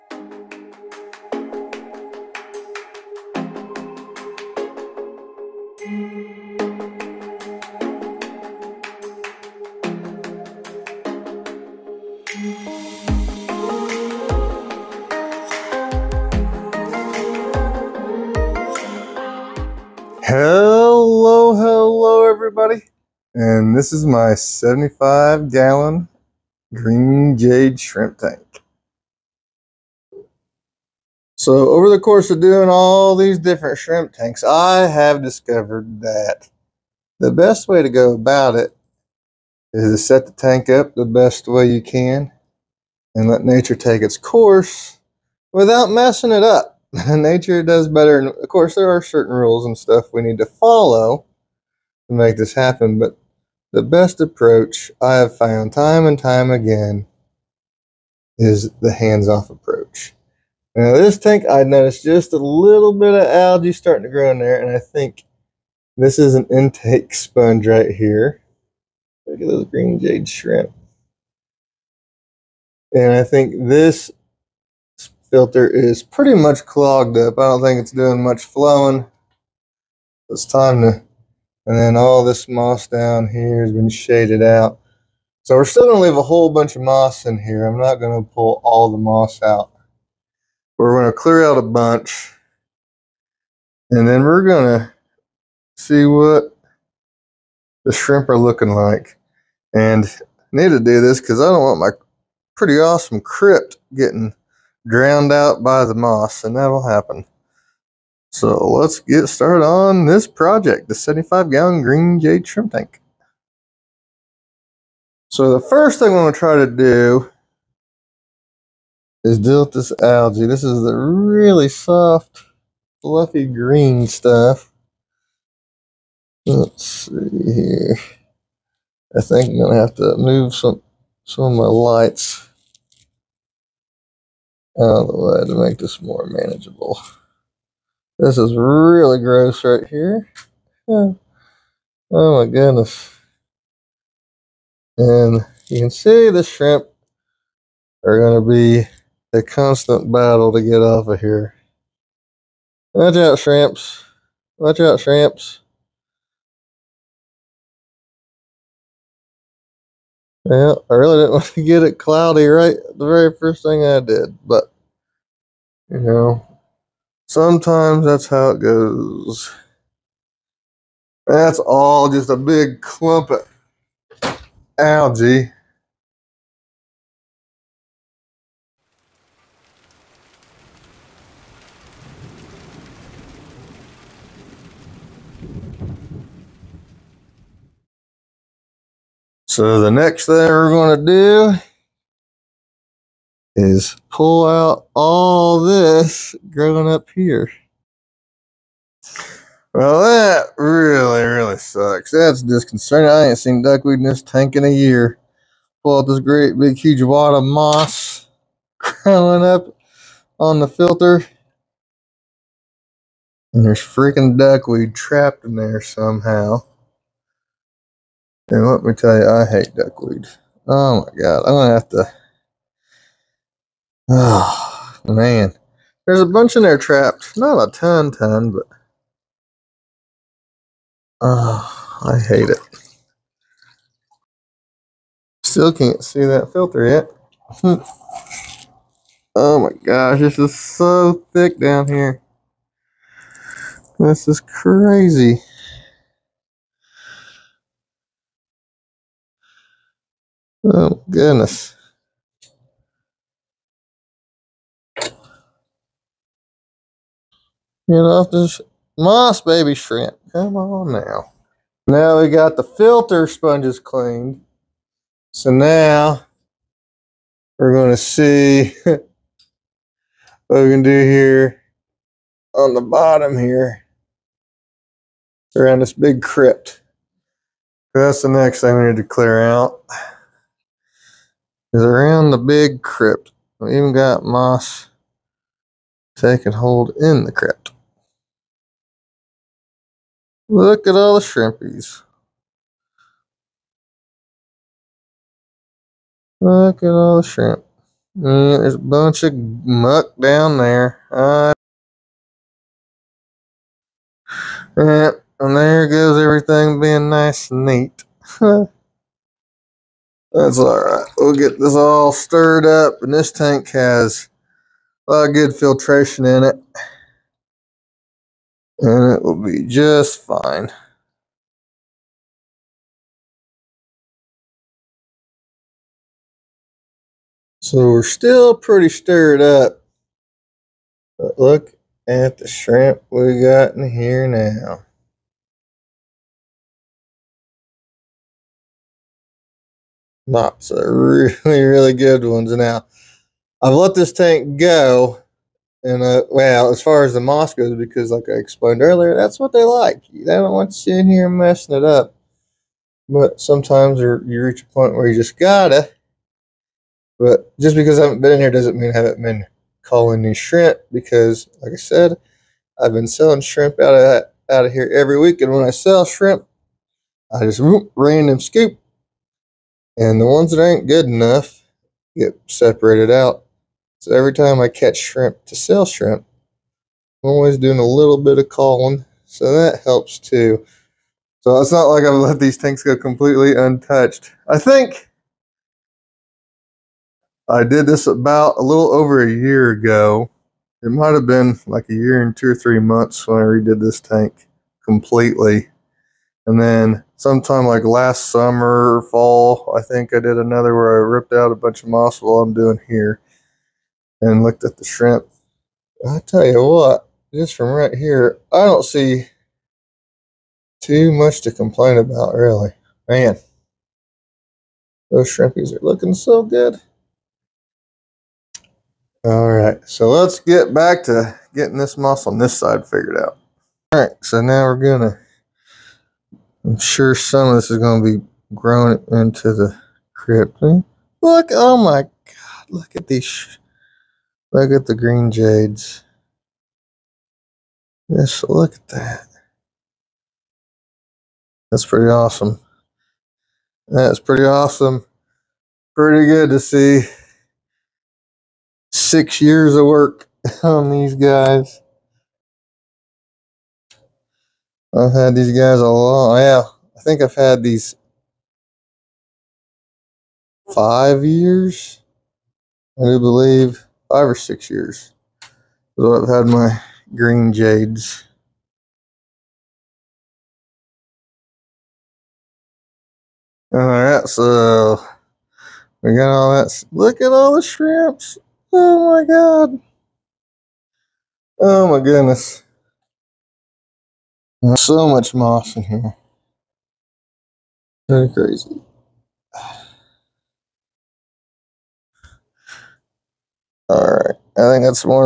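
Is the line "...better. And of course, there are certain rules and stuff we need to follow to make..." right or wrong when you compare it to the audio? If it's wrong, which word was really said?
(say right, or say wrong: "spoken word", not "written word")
right.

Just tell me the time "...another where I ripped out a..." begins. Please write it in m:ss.
6:40.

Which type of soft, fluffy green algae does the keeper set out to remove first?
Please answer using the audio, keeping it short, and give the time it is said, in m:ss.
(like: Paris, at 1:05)
Dilthus algae, at 1:59.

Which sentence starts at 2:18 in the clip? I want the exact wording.
This is really gross right here.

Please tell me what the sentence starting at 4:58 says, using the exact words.
Mm, there's a bunch of muck down there.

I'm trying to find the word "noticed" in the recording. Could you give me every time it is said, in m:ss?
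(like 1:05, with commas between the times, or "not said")
1:01.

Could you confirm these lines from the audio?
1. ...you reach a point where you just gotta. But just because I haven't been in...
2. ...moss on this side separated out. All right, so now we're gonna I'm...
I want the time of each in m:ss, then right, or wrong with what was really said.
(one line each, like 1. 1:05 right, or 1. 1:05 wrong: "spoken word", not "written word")
1. 5:53 right
2. 7:01 wrong: "figured", not "separated".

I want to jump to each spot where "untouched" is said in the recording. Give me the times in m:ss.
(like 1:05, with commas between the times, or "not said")
6:23.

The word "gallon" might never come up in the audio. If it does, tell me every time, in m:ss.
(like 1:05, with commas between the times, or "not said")
0:25, 1:51.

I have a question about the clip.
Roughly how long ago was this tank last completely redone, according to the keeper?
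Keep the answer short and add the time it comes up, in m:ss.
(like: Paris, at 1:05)
a little over a year, at 6:28.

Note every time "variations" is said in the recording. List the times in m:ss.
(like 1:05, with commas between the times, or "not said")
not said.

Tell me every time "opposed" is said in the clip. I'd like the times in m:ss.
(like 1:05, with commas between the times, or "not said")
not said.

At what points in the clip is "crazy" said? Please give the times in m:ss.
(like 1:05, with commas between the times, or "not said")
4:04, 8:08.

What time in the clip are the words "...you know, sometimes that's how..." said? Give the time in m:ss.
2:45.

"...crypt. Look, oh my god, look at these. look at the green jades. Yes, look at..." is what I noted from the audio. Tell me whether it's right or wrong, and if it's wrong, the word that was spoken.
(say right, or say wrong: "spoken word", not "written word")
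right.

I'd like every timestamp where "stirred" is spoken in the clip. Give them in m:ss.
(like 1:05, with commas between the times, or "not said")
5:12, 5:28.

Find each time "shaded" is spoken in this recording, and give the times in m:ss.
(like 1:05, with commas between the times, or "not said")
1:23.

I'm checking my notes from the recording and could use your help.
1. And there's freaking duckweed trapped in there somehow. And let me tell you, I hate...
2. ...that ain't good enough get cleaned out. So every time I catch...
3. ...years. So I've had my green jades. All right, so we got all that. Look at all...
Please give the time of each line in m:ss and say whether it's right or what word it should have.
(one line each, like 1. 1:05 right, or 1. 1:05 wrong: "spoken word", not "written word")
1. 3:33 right
2. 6:10 wrong: "separated", not "cleaned"
3. 7:44 right.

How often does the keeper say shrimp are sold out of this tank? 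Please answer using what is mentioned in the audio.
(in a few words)
every week.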